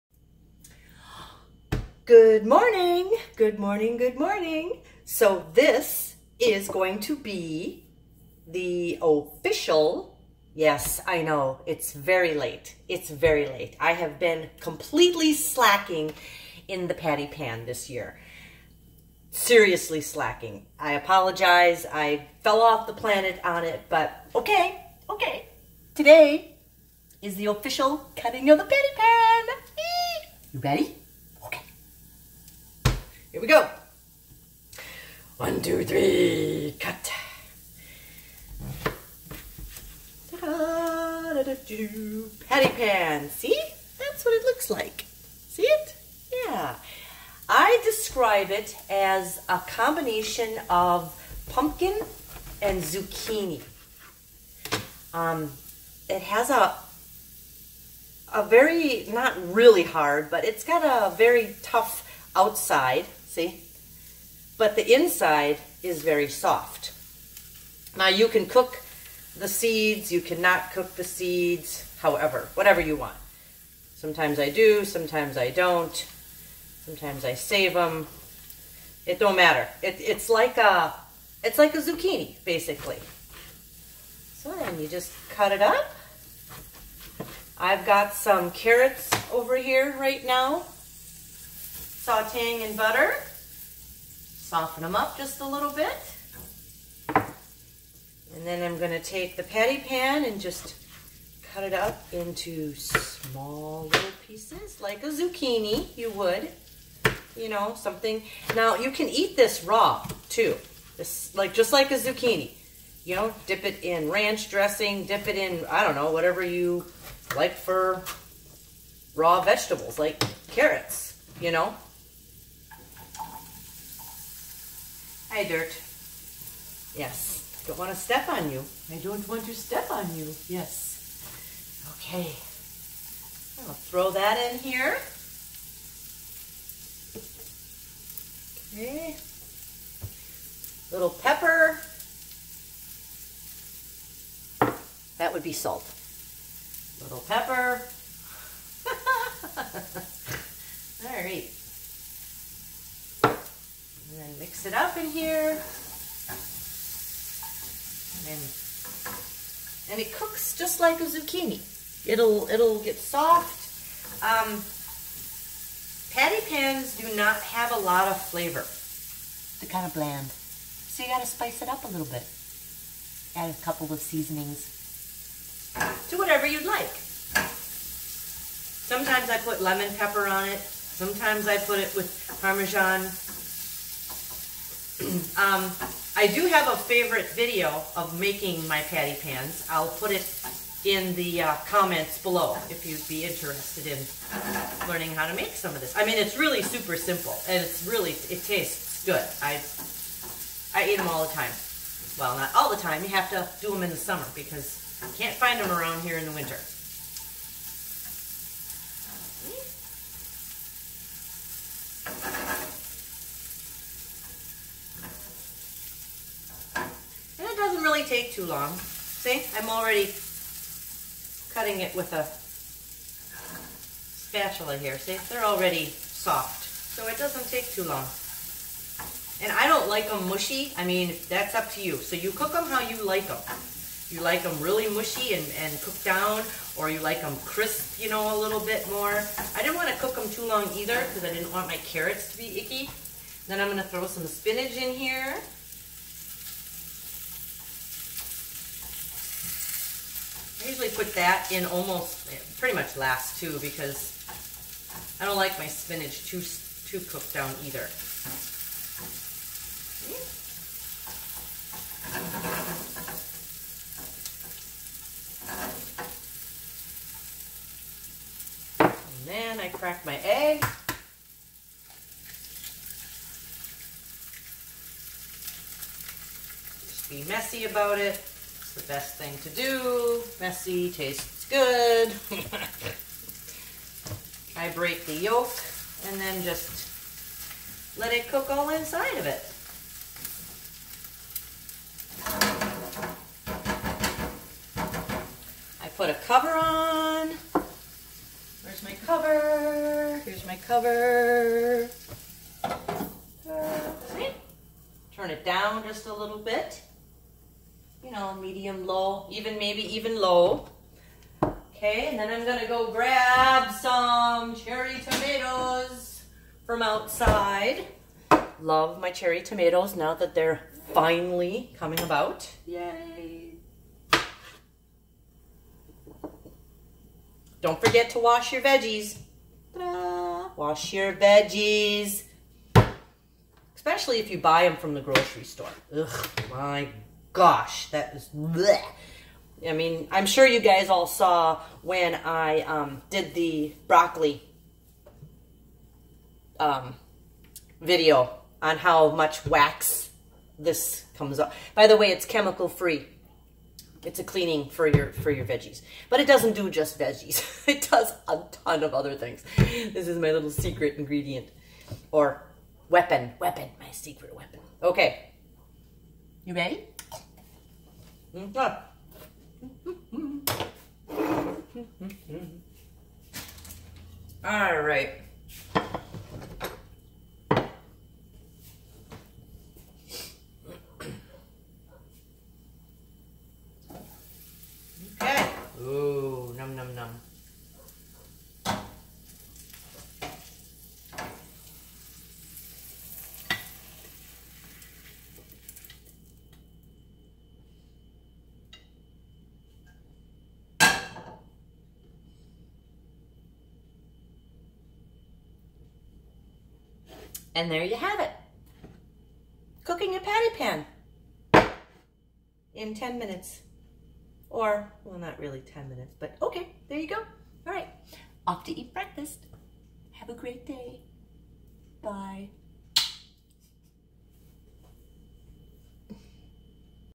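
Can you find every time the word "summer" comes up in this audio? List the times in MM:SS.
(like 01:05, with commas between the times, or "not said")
03:23.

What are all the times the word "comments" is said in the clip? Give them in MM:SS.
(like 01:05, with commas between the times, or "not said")
03:11.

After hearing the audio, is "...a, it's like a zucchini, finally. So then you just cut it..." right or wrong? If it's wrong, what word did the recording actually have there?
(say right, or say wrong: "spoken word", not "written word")
wrong: "basically", not "finally".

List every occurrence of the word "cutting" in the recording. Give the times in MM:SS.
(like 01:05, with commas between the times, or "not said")
00:28, 03:41.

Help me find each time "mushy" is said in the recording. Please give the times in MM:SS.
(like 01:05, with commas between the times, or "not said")
03:50, 03:54.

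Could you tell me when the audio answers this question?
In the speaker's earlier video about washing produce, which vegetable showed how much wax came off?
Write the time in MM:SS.
05:43.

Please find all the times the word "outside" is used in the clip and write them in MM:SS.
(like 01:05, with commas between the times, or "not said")
01:02, 05:16.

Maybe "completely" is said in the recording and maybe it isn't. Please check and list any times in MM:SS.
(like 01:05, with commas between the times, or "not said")
00:14.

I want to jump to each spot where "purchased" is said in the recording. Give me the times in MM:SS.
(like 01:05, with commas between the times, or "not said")
not said.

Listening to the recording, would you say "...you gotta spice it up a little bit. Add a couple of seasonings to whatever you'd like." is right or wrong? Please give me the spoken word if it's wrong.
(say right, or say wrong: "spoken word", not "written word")
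right.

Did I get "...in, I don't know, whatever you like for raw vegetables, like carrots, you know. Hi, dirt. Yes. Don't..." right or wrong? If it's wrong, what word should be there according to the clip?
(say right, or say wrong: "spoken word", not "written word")
right.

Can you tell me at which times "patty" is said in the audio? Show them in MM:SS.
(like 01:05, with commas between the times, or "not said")
00:16, 00:28, 00:42, 01:39, 02:46, 03:08, 06:50.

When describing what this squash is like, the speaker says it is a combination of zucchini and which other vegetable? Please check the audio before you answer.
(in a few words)
pumpkin.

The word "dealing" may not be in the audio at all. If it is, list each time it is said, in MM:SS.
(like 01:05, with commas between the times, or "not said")
not said.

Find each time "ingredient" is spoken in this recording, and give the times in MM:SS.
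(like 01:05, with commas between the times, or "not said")
06:00.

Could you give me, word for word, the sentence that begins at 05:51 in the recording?
By the way, it's chemical free.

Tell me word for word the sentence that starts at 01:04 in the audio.
But the inside is very soft.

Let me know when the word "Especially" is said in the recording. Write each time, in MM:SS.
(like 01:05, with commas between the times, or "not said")
05:33.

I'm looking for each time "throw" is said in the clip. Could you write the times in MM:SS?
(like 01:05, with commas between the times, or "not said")
02:13, 04:03.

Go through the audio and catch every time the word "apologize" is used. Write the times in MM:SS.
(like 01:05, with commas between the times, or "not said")
00:20.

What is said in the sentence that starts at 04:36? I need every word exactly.
Just be messy about it the best thing to do.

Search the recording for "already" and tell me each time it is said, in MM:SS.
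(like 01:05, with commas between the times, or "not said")
03:39, 03:45.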